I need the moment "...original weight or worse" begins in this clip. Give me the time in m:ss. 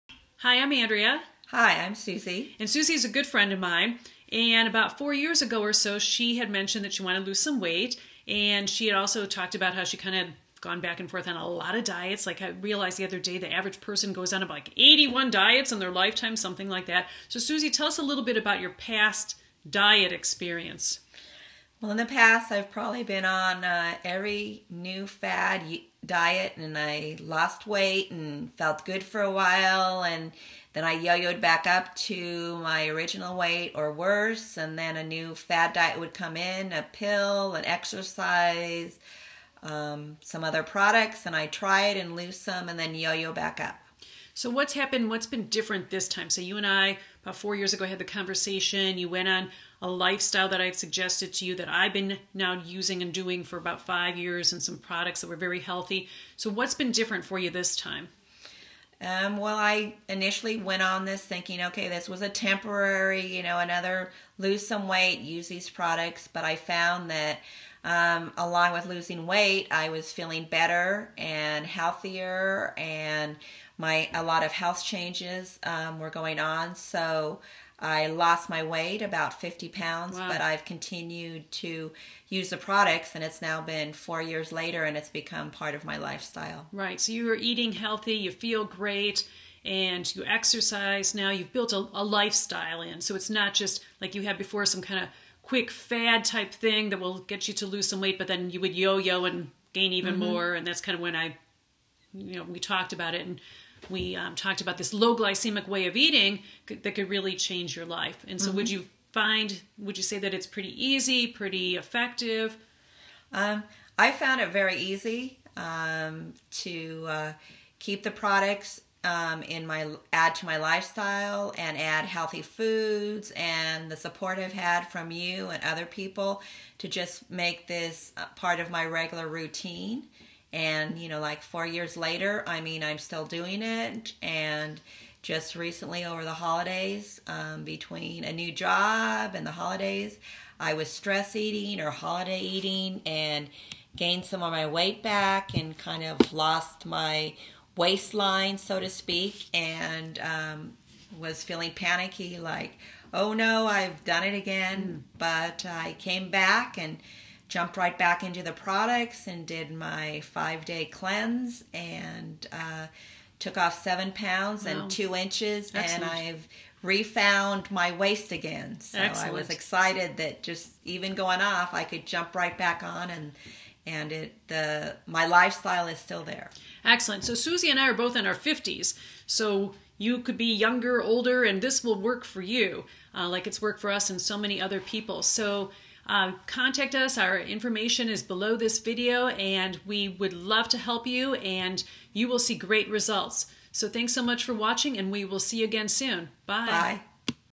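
0:32.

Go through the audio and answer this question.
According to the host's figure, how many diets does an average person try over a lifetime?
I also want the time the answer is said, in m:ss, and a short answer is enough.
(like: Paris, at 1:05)
81, at 0:14.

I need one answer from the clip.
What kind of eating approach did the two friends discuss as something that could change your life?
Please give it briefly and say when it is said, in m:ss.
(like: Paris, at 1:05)
low glycemic, at 1:44.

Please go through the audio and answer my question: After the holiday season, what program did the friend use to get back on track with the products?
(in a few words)
five day cleanse.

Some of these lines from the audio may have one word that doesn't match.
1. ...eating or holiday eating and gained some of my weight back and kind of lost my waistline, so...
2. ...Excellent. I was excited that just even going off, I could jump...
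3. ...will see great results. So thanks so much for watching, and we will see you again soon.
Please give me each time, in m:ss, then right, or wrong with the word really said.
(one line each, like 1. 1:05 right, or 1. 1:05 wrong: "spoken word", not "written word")
1. 2:21 right
2. 2:48 right
3. 3:12 right.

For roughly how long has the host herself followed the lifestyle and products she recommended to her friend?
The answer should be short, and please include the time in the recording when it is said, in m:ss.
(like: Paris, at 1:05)
about five years, at 0:53.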